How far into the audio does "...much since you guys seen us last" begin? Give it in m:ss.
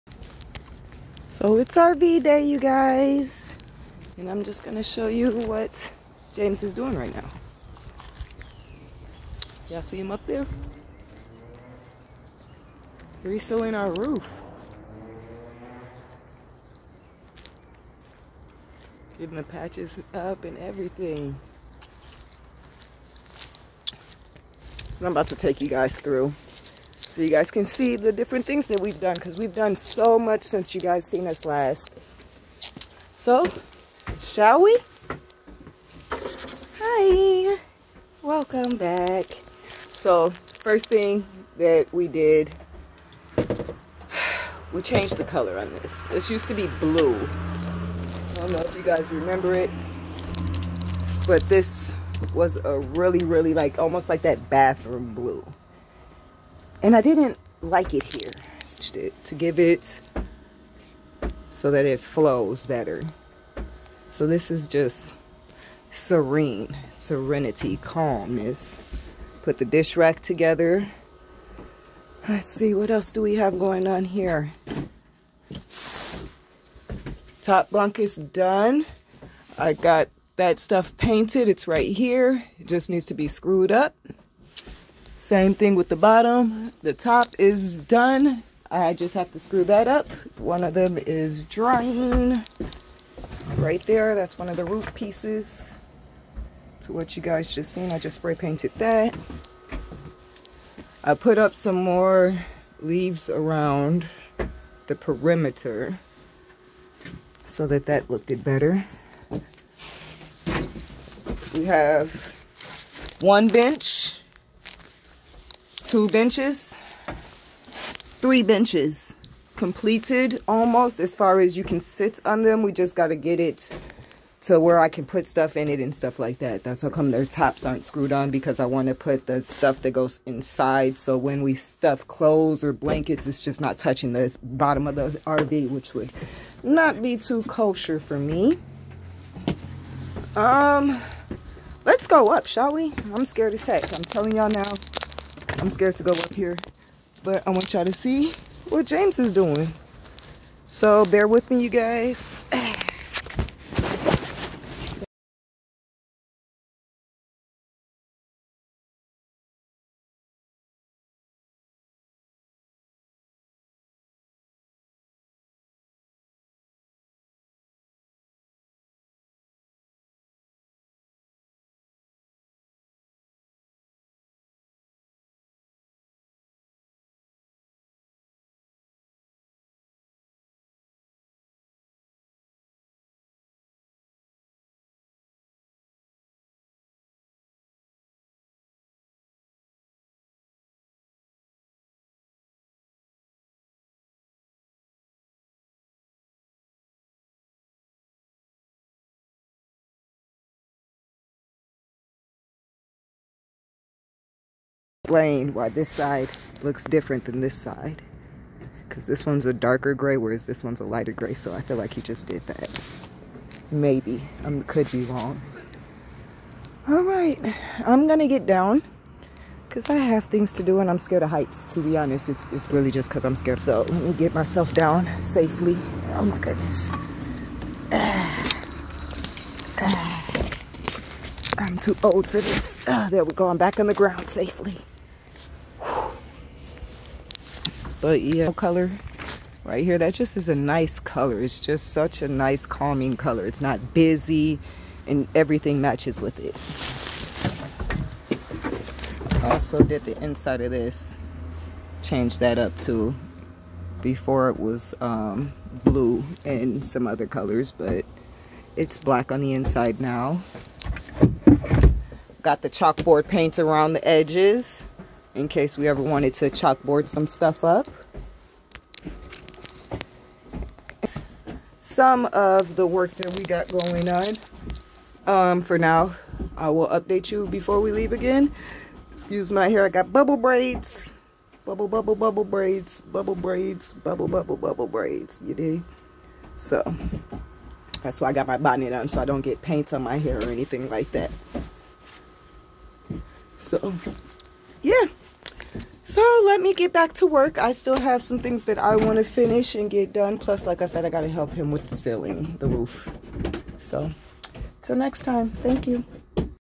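0:30.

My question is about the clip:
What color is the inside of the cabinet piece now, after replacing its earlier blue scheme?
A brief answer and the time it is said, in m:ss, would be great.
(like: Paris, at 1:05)
Black, at 4:18.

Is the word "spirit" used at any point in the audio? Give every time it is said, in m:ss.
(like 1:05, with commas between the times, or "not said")
not said.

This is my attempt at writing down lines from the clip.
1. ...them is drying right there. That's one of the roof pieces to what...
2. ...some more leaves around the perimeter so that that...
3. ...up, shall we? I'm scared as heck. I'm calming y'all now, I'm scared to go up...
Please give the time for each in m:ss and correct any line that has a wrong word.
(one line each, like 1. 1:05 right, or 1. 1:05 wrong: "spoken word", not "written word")
1. 1:30 right
2. 1:41 right
3. 2:22 wrong: "telling", not "calming".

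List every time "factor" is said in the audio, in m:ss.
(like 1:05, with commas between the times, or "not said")
not said.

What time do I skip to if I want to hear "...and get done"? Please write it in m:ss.
4:59.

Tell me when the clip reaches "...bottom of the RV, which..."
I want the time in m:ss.
2:14.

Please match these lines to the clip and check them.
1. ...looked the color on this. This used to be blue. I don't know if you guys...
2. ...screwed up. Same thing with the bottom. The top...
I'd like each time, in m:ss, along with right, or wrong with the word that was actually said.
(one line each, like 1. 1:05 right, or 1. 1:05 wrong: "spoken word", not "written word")
1. 0:44 wrong: "changed", not "looked"
2. 1:23 right.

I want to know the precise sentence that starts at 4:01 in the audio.
It's just such a nice calming color.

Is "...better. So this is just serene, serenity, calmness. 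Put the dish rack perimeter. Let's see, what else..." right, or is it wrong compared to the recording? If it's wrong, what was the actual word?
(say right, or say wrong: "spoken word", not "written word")
wrong: "together", not "perimeter".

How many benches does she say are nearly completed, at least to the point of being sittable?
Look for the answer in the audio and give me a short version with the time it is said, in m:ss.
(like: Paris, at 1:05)
3, at 1:58.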